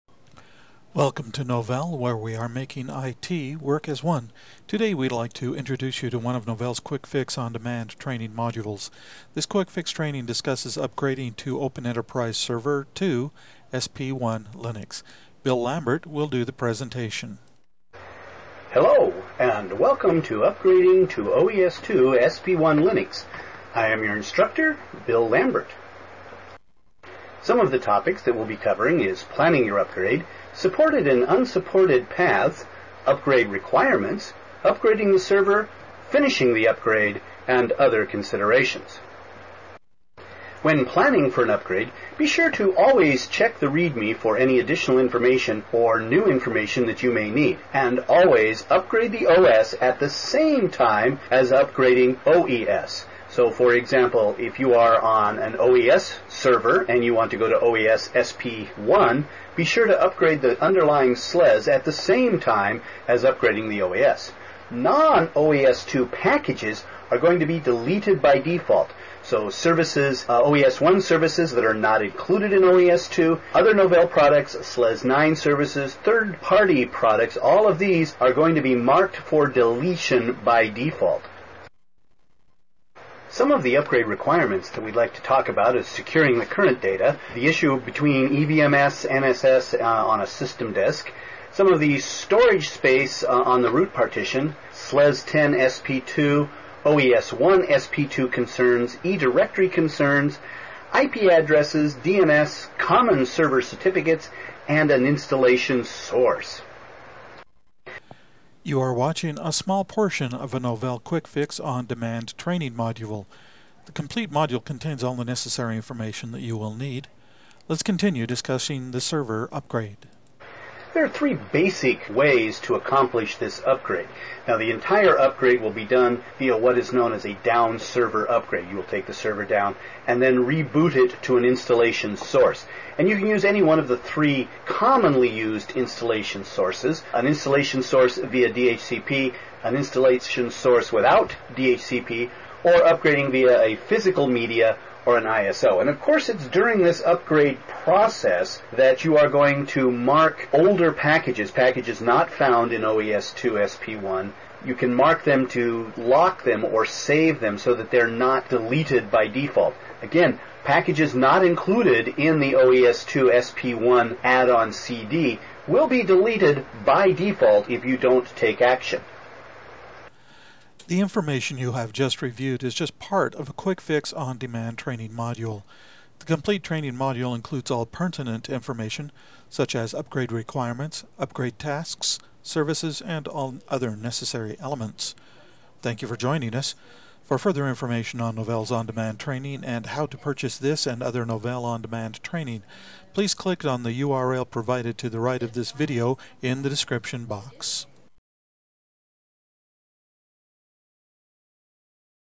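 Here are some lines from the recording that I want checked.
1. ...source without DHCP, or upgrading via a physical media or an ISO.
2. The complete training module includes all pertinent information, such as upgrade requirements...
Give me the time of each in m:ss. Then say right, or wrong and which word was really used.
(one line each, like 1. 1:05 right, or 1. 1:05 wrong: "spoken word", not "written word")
1. 2:20 right
2. 2:56 right.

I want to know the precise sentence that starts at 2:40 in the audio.
Again, packages not included in the OES2 SP1 add-on CD will be deleted by default if you don't take action.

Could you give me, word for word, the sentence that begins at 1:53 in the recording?
The complete module contains all the necessary information that you will need.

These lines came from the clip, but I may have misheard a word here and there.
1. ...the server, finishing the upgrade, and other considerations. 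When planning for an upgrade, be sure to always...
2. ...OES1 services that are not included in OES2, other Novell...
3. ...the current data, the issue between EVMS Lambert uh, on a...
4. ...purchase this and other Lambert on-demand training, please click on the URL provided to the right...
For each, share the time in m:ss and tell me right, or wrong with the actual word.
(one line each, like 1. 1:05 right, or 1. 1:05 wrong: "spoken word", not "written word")
1. 0:35 right
2. 1:10 right
3. 1:26 wrong: "NSS", not "Lambert"
4. 3:10 wrong: "Novell", not "Lambert".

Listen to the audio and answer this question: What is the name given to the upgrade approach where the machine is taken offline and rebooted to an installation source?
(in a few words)
Down server upgrade.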